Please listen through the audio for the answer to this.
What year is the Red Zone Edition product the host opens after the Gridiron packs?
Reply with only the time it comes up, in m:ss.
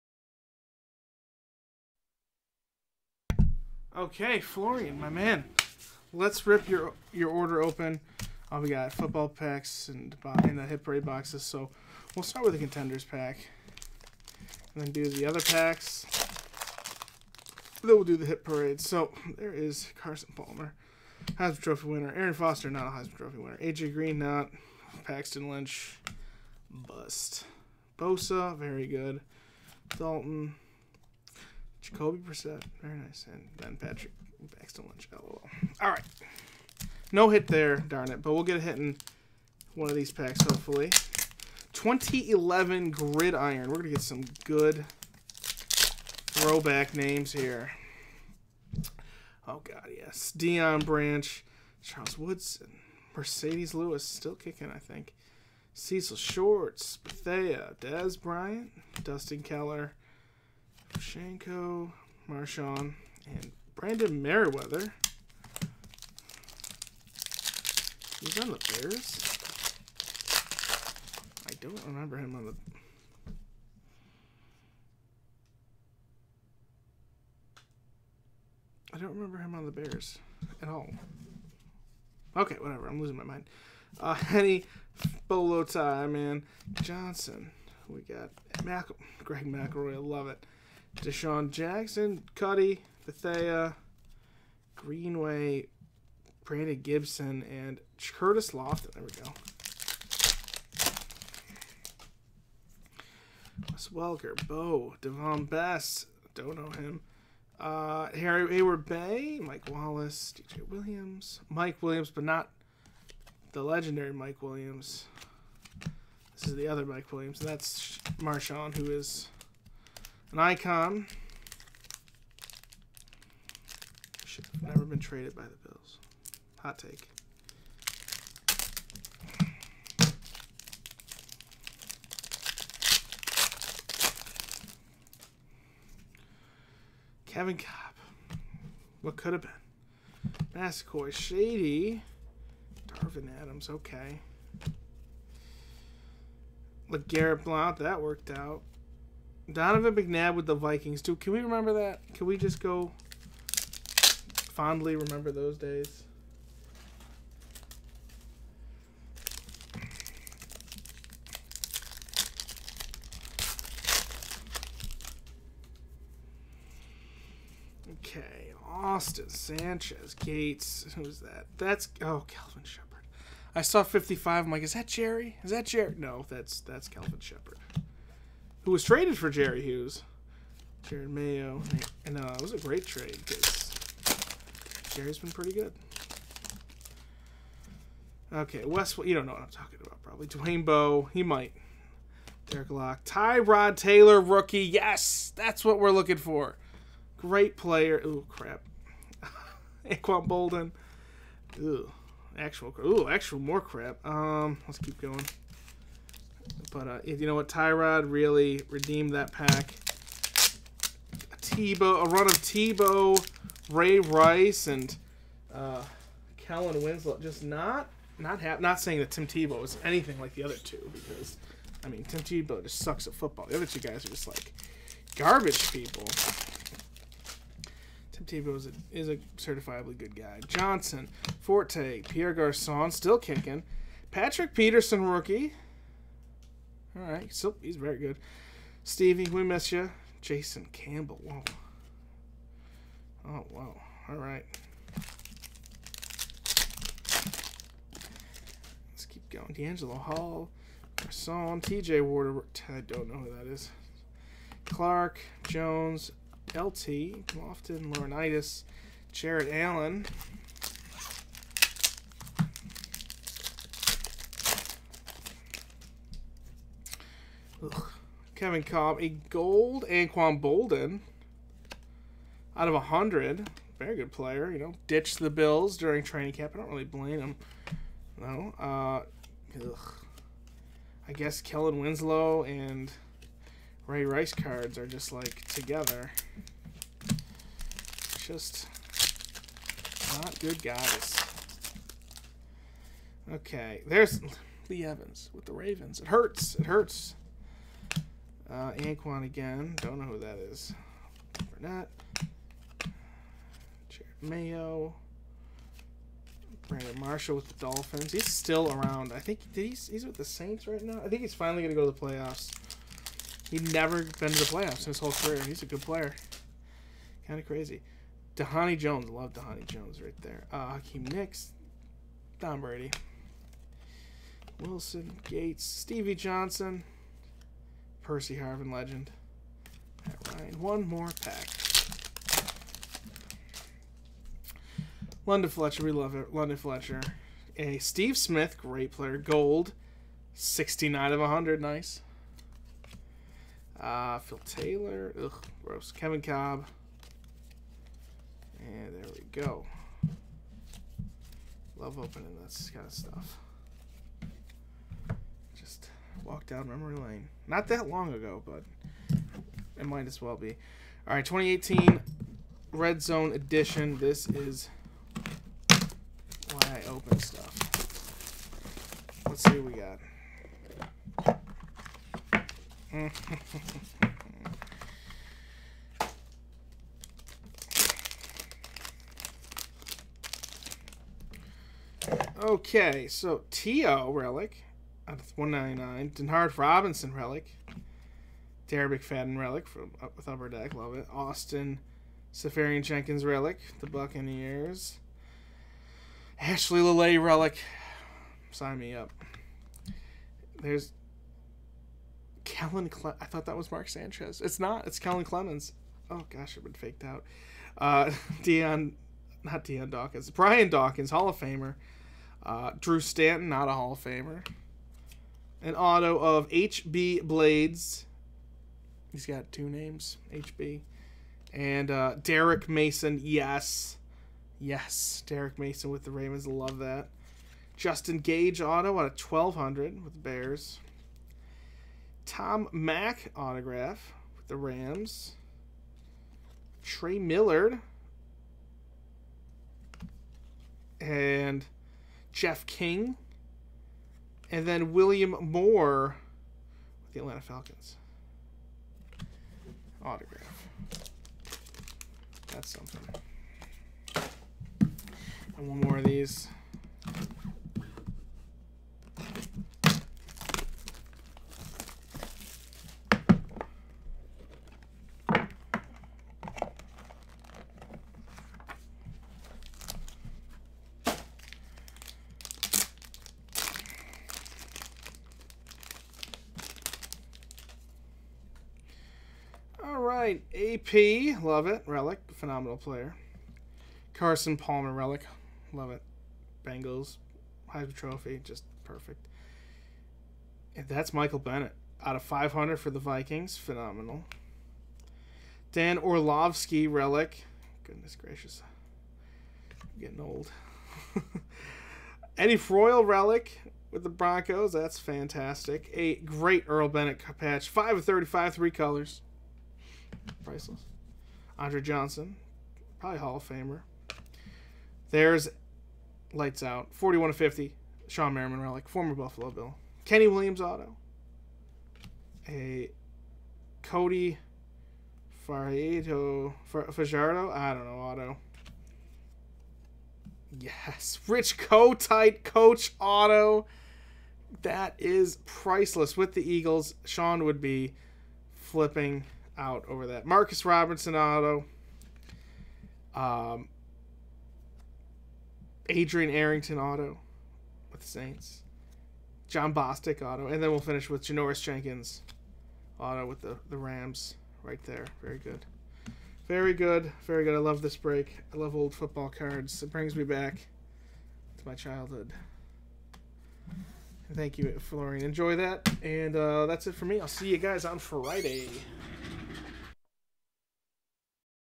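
6:01.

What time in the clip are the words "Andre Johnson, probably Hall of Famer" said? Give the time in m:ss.
8:31.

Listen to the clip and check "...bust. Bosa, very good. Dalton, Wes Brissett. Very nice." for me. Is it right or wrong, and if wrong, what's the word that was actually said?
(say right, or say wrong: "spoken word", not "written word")
wrong: "Jacoby", not "Wes".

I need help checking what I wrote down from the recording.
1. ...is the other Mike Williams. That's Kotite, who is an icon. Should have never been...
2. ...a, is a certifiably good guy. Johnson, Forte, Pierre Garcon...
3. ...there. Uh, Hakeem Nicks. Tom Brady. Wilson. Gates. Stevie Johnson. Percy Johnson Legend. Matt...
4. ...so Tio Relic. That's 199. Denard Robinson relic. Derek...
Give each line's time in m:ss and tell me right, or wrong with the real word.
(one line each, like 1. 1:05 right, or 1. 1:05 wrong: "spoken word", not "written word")
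1. 1:56 wrong: "Marshawn", not "Kotite"
2. 3:48 right
3. 5:20 wrong: "Harvin", not "Johnson"
4. 6:23 right.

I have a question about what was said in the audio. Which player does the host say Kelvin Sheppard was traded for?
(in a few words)
Jerry Hughes.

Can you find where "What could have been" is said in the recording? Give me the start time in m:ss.
2:19.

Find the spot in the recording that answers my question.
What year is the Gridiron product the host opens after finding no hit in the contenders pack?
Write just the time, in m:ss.
0:41.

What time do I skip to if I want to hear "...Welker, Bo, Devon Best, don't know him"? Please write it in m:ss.
1:43.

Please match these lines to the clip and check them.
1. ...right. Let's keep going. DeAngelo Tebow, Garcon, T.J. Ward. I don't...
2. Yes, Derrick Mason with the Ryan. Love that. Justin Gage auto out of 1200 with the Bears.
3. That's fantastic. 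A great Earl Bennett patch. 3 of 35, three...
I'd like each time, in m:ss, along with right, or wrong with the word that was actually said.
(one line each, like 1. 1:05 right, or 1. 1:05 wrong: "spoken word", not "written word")
1. 4:04 wrong: "Hall", not "Tebow"
2. 7:04 wrong: "Ravens", not "Ryan"
3. 8:24 wrong: "5", not "3".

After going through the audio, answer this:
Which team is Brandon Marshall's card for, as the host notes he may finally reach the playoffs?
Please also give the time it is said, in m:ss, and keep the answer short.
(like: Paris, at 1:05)
the Dolphins, at 5:07.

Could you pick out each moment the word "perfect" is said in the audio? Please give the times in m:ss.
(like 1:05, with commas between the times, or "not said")
8:08.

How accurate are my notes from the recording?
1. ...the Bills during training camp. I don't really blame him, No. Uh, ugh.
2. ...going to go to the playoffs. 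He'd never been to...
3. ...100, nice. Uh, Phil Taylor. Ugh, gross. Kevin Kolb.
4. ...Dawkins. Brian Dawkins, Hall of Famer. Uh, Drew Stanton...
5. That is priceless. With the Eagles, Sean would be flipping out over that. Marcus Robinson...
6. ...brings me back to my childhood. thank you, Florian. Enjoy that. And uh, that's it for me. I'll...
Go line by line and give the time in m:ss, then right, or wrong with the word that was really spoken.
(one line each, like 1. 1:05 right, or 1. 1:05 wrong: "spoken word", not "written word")
1. 4:35 right
2. 5:11 right
3. 5:41 right
4. 6:49 right
5. 8:54 right
6. 9:19 right.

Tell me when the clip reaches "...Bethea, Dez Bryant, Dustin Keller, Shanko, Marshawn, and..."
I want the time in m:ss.
0:56.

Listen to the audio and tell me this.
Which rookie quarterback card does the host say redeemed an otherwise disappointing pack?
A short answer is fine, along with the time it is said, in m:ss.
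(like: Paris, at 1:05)
Tyrod Taylor, at 3:13.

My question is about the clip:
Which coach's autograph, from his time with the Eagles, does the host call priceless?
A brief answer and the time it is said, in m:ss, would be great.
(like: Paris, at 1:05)
Rich Kotite, at 8:51.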